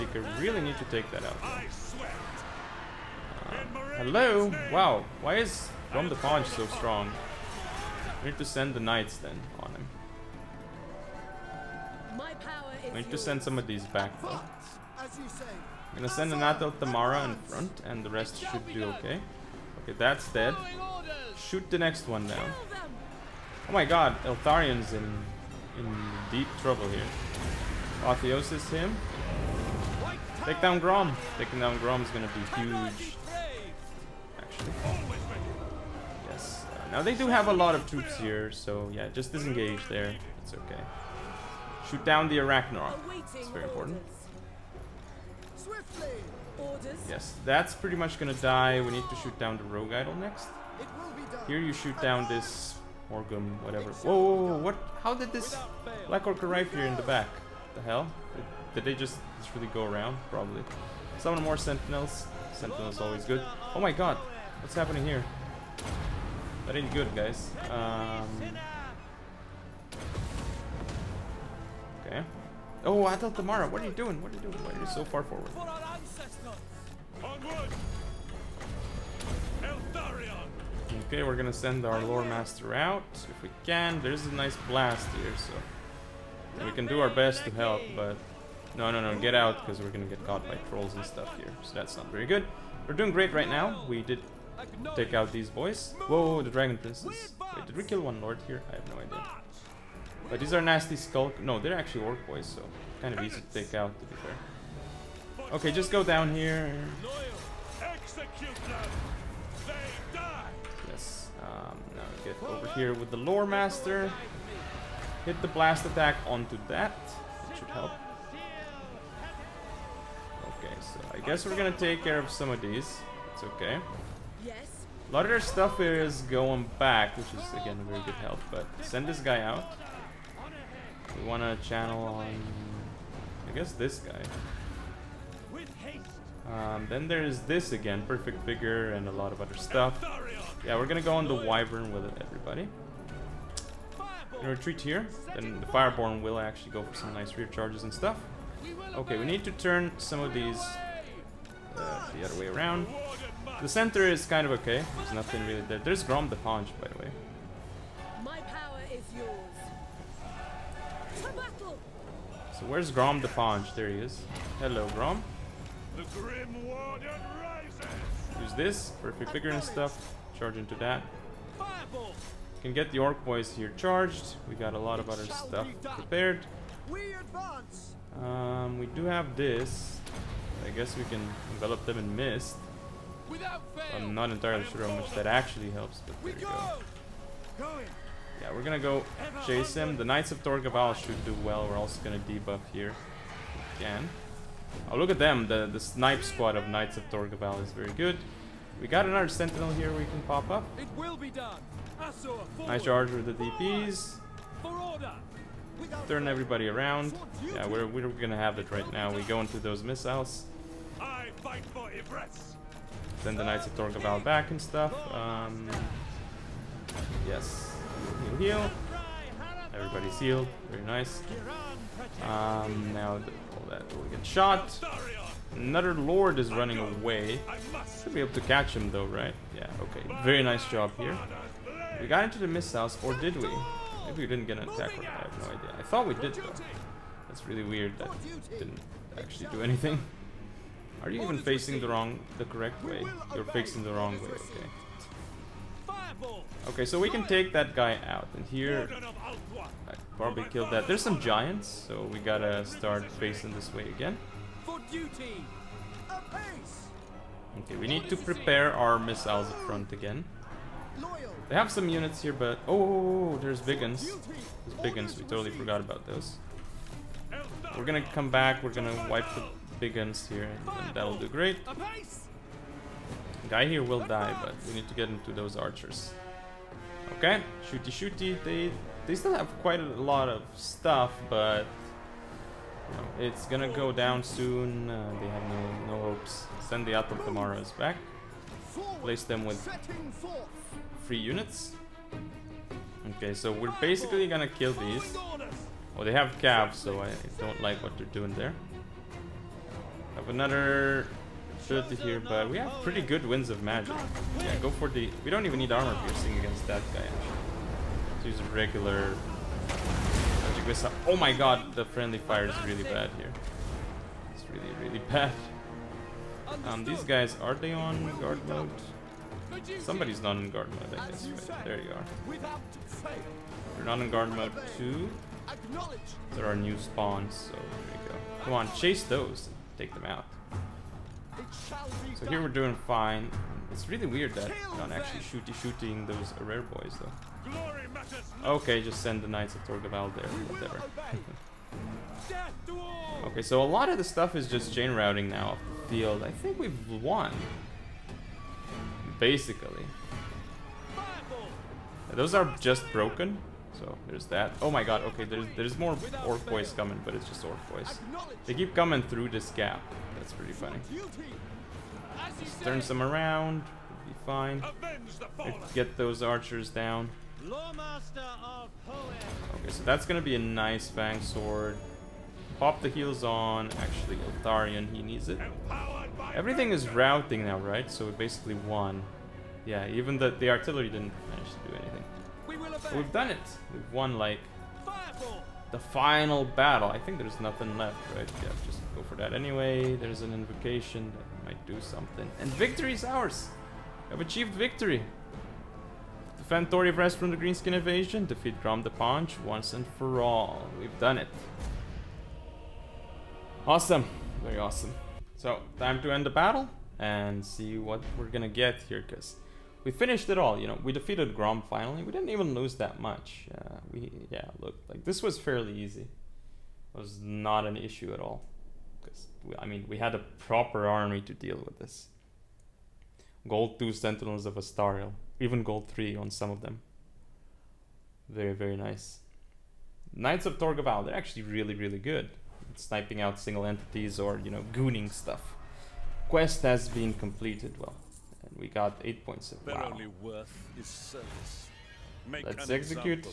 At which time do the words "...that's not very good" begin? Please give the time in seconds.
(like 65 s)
91 s.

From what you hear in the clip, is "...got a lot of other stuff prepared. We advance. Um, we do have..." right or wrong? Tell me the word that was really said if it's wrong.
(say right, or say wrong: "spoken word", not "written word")
right.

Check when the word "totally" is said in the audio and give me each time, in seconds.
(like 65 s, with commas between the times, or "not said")
265 s.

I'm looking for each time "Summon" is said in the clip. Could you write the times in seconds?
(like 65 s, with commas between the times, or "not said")
61 s.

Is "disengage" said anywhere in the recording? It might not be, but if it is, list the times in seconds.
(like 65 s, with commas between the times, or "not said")
39 s.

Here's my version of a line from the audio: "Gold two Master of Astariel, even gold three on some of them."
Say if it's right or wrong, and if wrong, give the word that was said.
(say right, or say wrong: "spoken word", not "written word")
wrong: "Sentinels", not "Master".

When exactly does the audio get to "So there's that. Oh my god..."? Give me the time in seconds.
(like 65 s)
353 s.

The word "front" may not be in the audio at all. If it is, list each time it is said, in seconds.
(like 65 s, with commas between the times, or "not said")
17 s, 259 s.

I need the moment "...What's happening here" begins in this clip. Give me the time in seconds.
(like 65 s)
64 s.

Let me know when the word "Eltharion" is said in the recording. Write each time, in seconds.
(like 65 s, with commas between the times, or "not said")
24 s, 374 s.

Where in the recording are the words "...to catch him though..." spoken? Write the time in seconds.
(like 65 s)
228 s.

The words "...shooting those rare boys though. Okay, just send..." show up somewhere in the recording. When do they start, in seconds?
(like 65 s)
335 s.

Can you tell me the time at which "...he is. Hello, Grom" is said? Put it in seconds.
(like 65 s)
163 s.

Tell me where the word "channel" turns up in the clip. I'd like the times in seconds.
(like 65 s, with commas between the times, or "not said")
131 s.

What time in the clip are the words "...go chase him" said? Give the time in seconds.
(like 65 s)
188 s.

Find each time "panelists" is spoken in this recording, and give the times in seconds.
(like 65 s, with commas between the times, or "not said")
not said.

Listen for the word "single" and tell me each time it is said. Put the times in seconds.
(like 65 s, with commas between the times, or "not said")
433 s.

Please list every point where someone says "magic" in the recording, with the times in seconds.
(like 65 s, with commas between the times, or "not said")
303 s, 309 s.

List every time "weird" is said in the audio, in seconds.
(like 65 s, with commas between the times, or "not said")
237 s, 334 s.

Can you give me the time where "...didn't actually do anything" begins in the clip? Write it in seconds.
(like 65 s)
238 s.